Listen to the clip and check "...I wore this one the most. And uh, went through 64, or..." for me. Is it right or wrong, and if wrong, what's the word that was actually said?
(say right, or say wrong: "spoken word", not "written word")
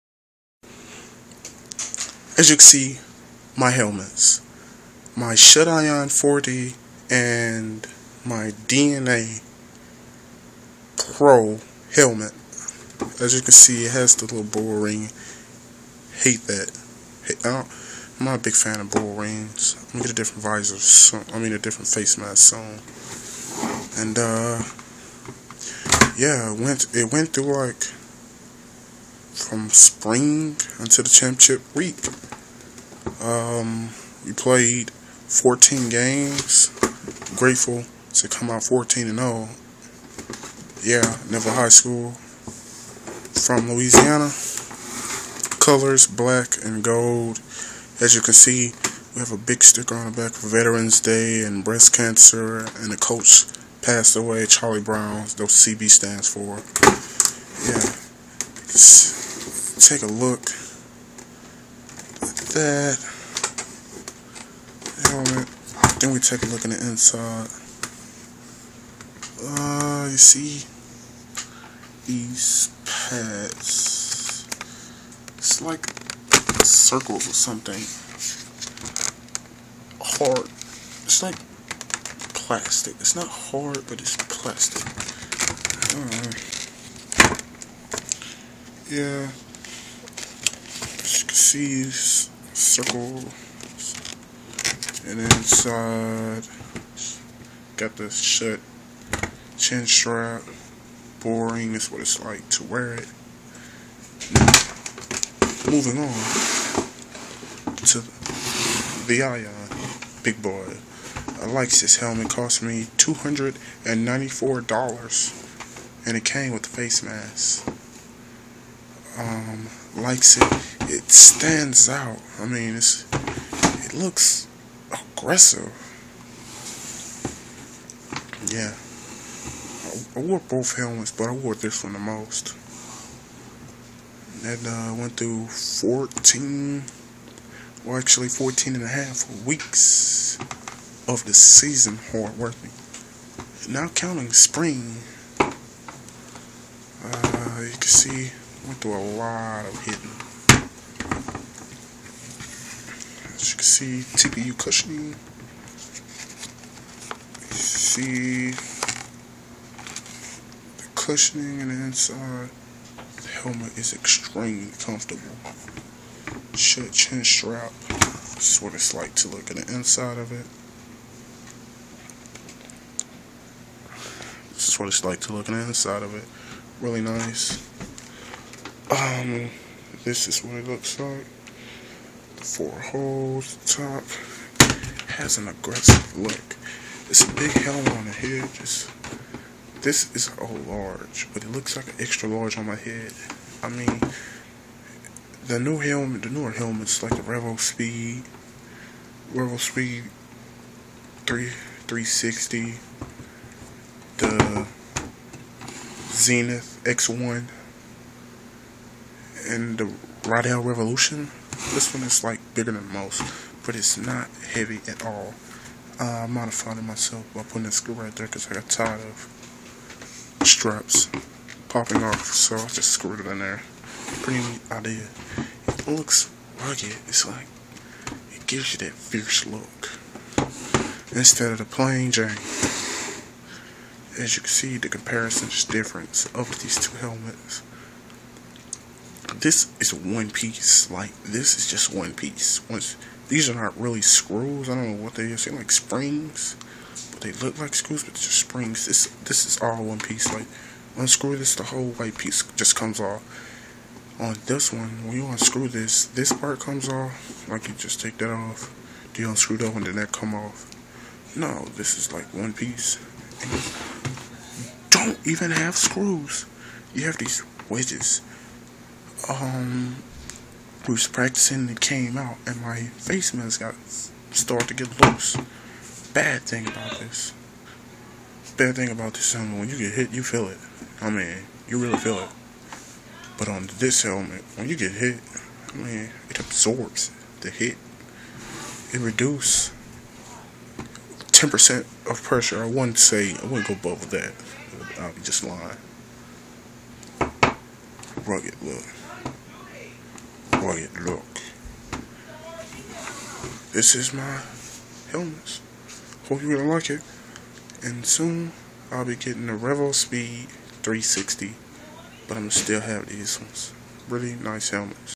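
wrong: "14", not "64".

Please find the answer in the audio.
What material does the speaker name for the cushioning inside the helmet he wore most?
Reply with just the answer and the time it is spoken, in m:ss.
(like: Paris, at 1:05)
TPU, at 2:34.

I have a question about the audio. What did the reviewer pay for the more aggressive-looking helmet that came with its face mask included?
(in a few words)
$294.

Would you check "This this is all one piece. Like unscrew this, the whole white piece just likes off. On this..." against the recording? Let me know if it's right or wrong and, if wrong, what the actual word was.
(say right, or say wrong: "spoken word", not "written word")
wrong: "comes", not "likes".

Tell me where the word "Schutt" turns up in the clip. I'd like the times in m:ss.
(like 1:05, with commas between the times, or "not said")
0:05, 1:38, 2:46.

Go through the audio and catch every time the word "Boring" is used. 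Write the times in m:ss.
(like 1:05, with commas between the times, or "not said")
1:41.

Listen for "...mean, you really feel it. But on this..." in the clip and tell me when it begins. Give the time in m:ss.
4:41.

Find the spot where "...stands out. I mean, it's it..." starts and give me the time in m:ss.
2:01.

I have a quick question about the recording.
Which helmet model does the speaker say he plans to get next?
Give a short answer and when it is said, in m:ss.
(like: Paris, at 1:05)
Revo Speed 360, at 5:09.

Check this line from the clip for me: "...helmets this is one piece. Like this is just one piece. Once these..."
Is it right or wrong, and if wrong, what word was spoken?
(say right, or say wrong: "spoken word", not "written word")
right.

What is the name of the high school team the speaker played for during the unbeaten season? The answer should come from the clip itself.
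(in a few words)
Neville High School.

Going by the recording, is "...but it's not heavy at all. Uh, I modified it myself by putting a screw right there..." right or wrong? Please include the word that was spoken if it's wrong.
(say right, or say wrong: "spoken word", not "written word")
right.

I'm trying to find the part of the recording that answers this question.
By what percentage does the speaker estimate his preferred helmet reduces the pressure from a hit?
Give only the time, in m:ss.
4:51.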